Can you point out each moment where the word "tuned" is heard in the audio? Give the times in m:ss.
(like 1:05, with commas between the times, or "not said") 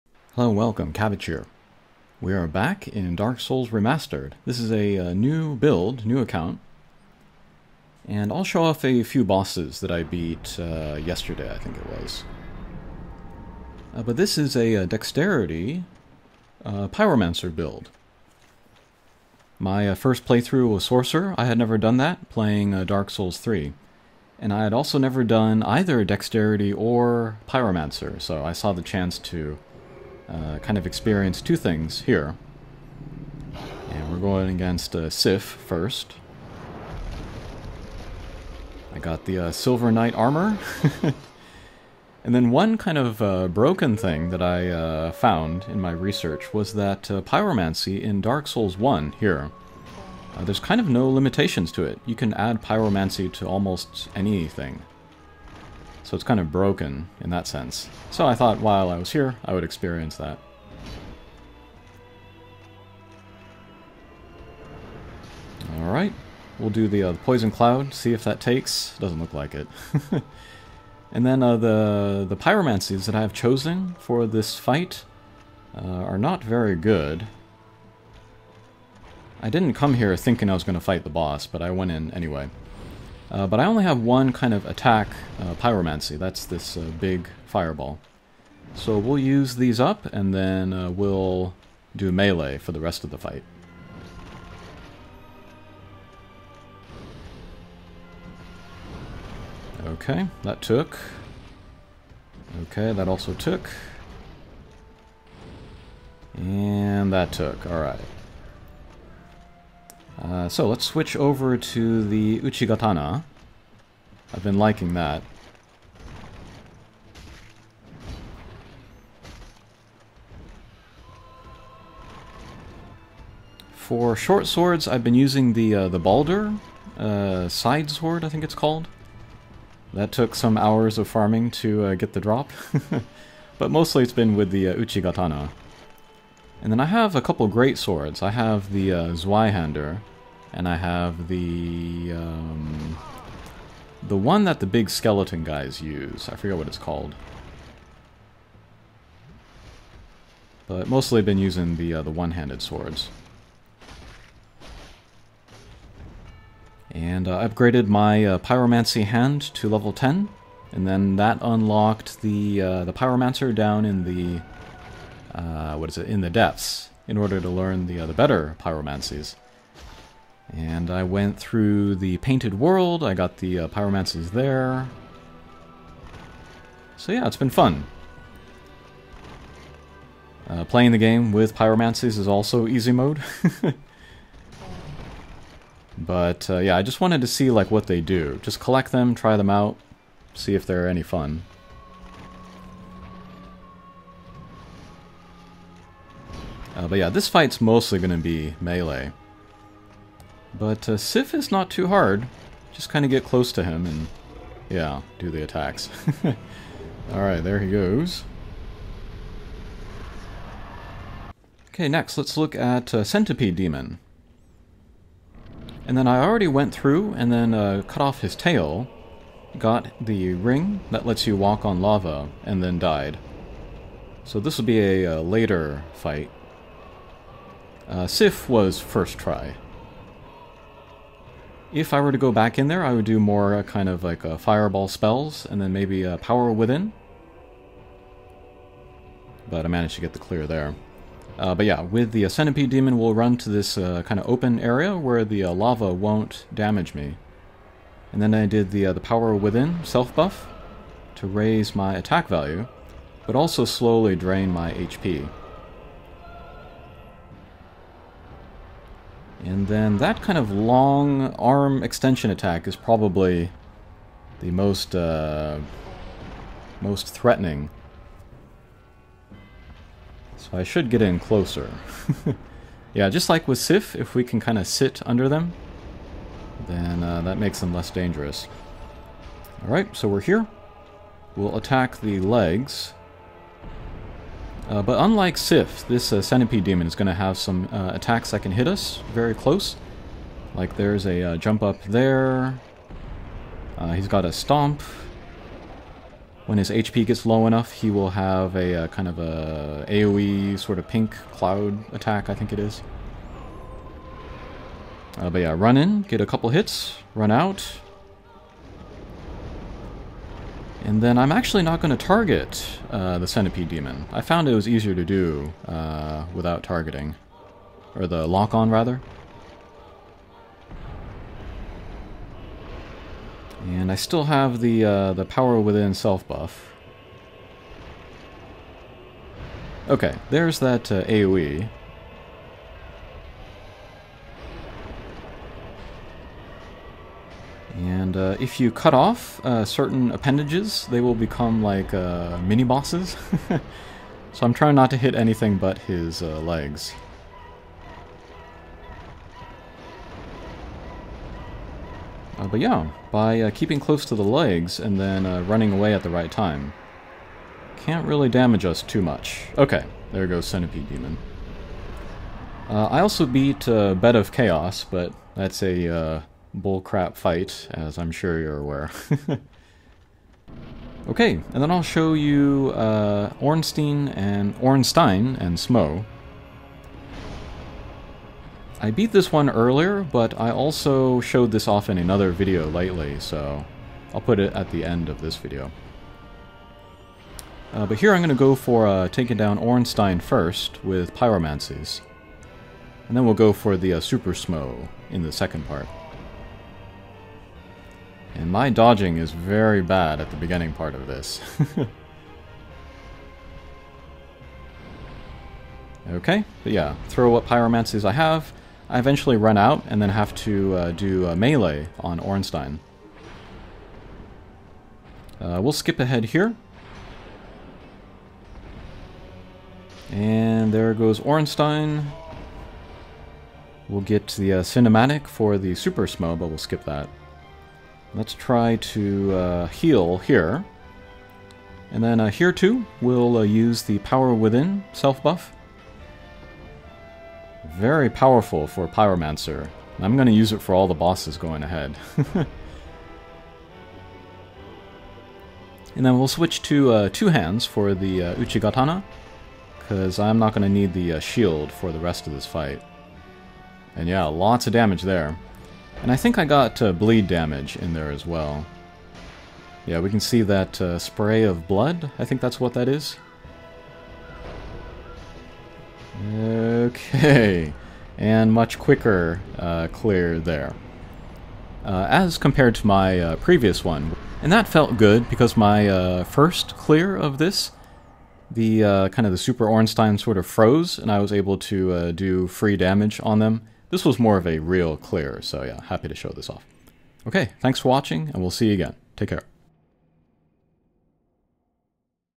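not said.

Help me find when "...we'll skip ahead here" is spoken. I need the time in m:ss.
6:55.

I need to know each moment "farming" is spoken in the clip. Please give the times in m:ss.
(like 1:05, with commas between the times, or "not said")
2:11.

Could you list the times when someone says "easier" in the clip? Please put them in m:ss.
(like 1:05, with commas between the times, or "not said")
5:14.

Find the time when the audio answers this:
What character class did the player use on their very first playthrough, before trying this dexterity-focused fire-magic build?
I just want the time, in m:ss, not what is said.
0:20.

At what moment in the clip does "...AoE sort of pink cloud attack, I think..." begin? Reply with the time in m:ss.
4:59.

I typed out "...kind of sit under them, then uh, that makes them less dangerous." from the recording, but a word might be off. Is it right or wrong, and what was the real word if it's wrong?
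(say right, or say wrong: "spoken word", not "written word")
right.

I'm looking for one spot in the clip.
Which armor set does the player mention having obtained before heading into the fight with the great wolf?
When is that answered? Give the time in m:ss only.
0:39.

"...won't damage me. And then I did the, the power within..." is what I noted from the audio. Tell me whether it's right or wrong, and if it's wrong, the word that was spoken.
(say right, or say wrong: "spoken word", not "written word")
right.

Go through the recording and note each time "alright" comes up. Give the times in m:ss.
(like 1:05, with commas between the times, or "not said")
1:05, 1:47, 3:27, 4:39.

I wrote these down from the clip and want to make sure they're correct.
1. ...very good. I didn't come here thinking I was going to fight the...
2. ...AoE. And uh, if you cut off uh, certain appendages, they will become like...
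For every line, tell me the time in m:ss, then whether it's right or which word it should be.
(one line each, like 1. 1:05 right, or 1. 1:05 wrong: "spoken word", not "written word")
1. 1:16 right
2. 5:31 right.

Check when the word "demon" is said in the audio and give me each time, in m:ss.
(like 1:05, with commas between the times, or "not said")
3:33, 4:02, 4:46, 5:13, 6:00.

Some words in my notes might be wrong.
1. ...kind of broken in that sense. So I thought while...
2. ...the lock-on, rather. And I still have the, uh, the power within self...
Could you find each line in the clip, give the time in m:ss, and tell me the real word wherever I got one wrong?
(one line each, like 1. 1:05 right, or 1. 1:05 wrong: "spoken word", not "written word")
1. 0:56 right
2. 5:18 right.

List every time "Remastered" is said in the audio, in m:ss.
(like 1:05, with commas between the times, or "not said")
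0:03.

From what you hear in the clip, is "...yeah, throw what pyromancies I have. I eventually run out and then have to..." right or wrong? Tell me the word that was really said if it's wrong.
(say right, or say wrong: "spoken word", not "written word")
right.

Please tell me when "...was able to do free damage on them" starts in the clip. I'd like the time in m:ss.
8:01.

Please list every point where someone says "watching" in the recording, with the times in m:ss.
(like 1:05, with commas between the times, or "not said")
8:07.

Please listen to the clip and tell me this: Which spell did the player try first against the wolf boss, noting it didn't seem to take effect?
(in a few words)
Poison Cloud.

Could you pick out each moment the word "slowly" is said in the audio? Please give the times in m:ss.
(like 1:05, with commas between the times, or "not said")
4:13.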